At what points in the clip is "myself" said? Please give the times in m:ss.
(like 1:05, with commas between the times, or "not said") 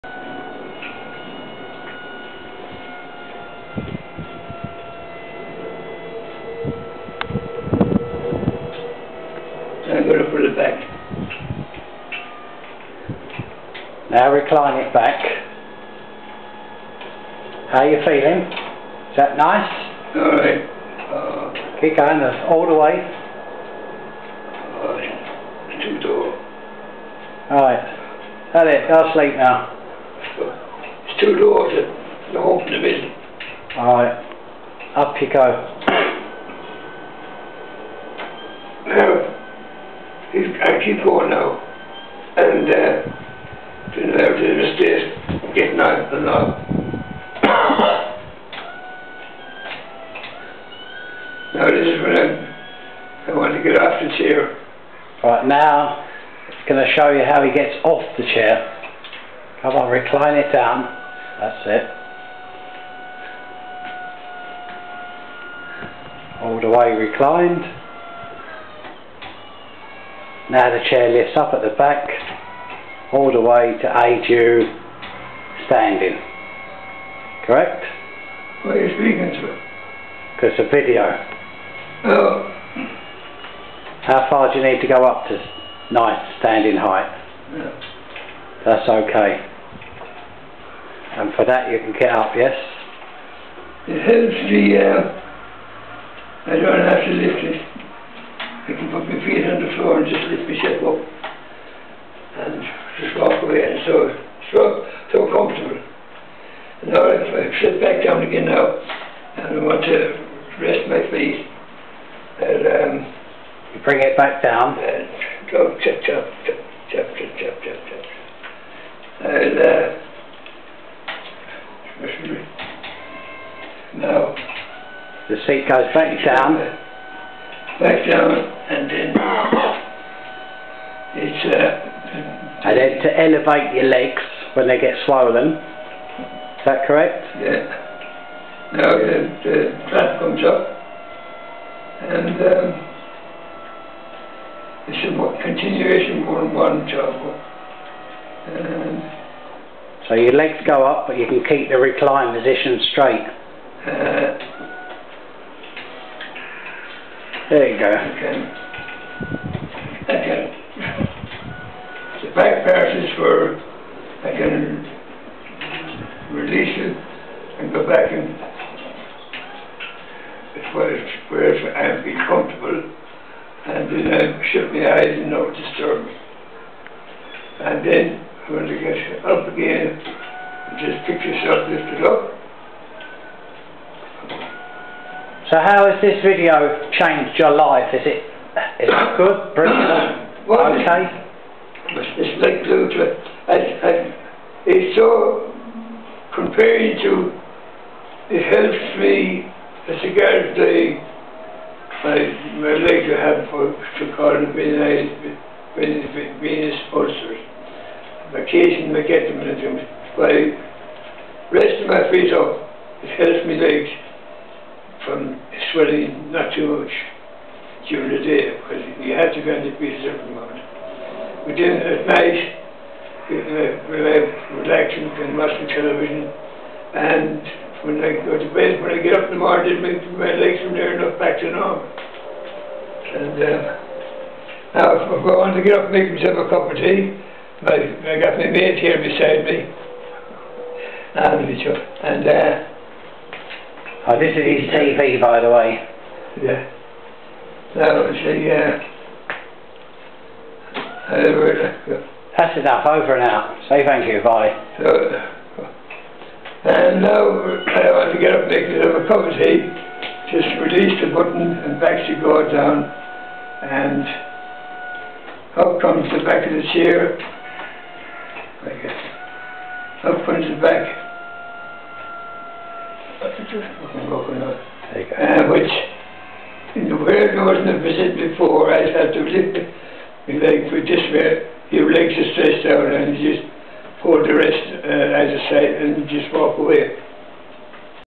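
1:40, 3:56.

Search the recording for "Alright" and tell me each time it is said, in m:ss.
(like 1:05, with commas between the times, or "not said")
0:20, 0:27, 0:33.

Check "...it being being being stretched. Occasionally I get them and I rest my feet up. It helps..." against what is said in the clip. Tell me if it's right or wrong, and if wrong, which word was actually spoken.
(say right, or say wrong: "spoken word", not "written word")
wrong: "sponsored", not "stretched".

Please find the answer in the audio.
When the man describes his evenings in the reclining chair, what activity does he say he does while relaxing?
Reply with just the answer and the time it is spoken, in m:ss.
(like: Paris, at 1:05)
Watching television, at 3:45.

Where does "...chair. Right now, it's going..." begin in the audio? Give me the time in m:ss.
0:54.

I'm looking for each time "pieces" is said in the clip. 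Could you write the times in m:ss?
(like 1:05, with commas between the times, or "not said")
3:39.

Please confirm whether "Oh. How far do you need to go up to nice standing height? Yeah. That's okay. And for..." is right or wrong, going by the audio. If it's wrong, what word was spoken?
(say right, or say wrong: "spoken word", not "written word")
right.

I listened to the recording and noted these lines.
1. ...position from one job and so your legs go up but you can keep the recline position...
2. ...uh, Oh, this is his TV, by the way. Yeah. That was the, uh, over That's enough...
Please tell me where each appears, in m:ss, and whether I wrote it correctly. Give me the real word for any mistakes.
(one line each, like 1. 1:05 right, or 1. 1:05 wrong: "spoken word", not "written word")
1. 2:25 wrong: "continuation", not "position"
2. 4:02 right.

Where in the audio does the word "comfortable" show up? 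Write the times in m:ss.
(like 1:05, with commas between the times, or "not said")
1:45, 2:52.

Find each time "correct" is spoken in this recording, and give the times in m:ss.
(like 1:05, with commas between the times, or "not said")
1:17, 2:16.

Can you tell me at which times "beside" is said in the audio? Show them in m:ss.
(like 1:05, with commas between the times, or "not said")
3:59.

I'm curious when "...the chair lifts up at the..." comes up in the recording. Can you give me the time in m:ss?
1:10.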